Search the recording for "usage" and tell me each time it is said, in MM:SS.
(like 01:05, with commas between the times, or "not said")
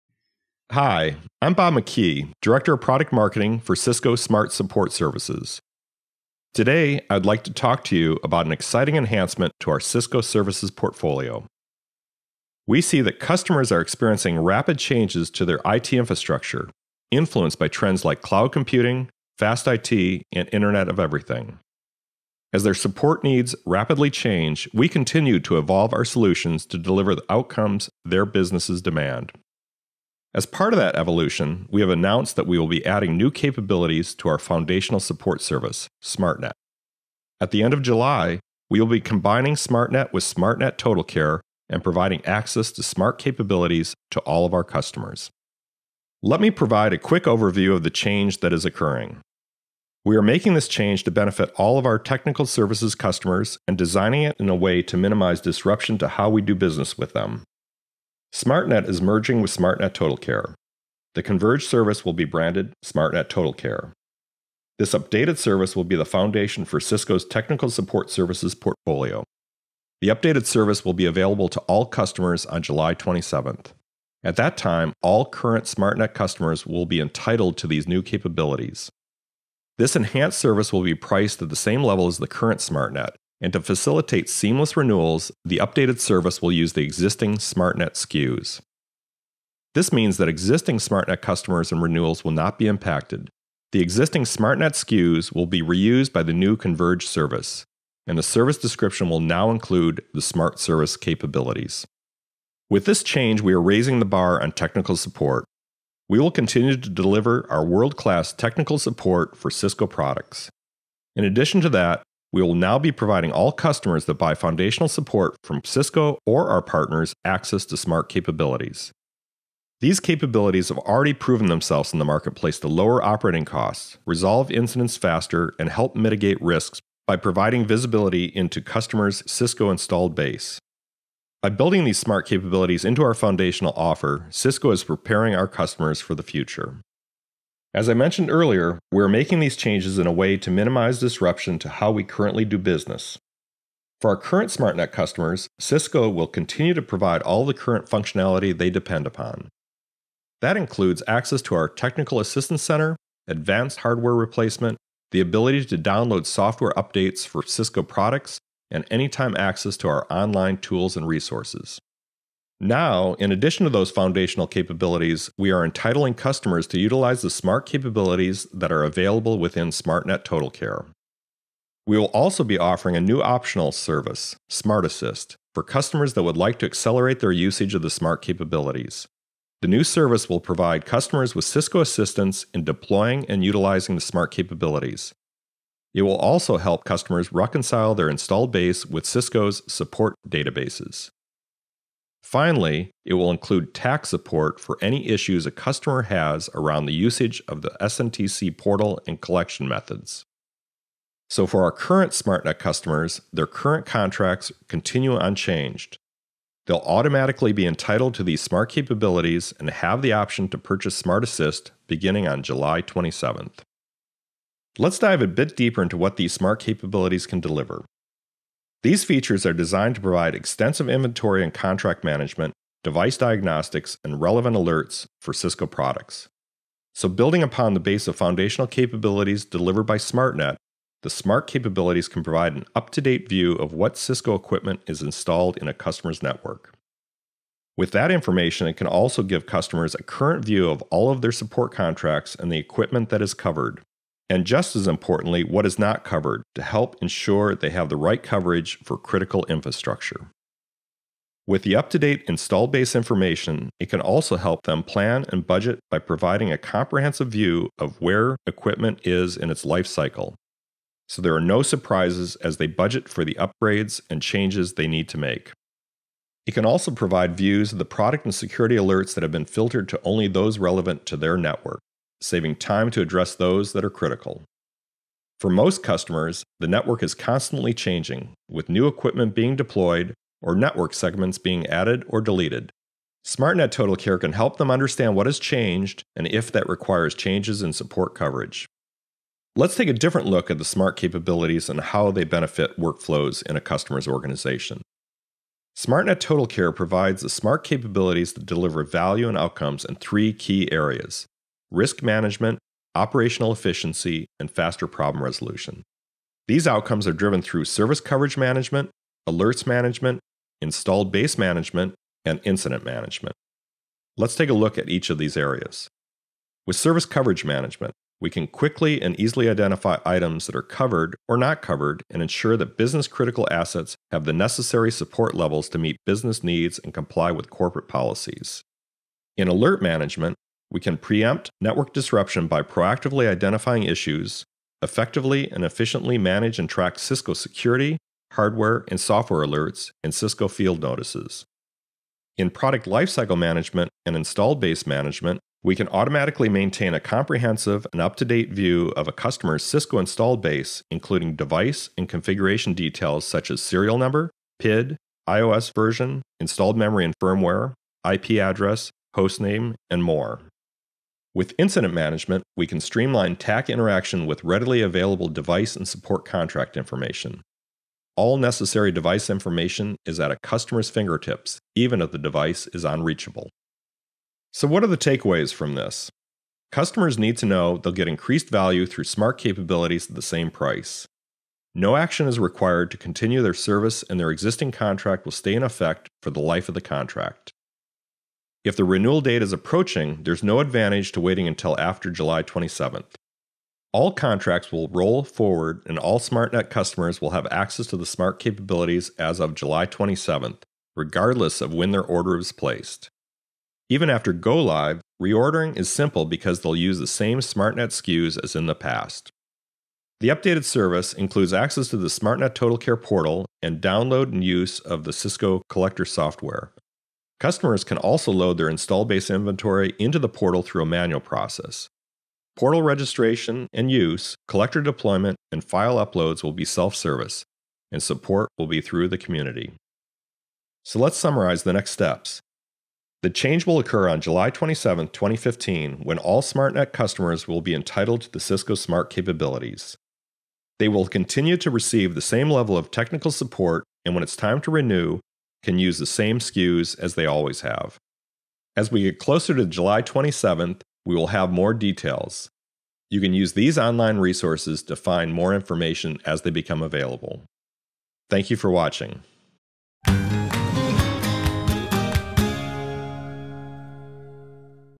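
02:57, 03:16.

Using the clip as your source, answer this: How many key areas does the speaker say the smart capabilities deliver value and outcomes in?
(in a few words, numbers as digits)
3.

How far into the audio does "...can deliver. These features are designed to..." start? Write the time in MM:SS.
03:37.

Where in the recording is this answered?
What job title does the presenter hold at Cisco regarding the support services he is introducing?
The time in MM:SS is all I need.
00:02.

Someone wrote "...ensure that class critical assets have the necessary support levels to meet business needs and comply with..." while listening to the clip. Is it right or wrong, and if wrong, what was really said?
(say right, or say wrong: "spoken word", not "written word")
wrong: "business", not "class".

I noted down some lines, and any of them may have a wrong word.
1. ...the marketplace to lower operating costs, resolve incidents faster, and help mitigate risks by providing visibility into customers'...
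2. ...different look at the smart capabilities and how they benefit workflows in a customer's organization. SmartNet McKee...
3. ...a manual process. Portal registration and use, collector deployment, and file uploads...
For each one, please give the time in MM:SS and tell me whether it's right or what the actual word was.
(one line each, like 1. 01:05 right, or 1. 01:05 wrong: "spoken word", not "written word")
1. 02:01 right
2. 04:49 wrong: "Total", not "McKee"
3. 07:00 right.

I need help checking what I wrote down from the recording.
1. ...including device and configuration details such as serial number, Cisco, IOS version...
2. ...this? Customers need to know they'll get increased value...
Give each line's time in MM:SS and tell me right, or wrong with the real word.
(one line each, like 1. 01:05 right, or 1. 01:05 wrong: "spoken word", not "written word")
1. 05:50 wrong: "PID", not "Cisco"
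2. 06:15 right.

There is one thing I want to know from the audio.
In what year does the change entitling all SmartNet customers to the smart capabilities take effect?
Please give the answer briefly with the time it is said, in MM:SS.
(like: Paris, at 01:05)
2015, at 07:15.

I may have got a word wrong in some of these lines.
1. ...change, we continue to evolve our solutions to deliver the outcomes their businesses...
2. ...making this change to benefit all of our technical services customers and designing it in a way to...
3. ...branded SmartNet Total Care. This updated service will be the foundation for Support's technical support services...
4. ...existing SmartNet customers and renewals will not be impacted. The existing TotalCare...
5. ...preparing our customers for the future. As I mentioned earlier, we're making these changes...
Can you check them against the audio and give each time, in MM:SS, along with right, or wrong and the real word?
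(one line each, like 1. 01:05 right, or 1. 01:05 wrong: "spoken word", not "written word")
1. 00:24 right
2. 00:50 right
3. 01:02 wrong: "Cisco", not "Support"
4. 01:30 wrong: "SmartNet", not "TotalCare"
5. 02:14 right.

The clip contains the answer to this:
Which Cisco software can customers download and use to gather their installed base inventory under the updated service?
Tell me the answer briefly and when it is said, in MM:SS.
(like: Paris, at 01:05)
Cisco Collector, at 06:55.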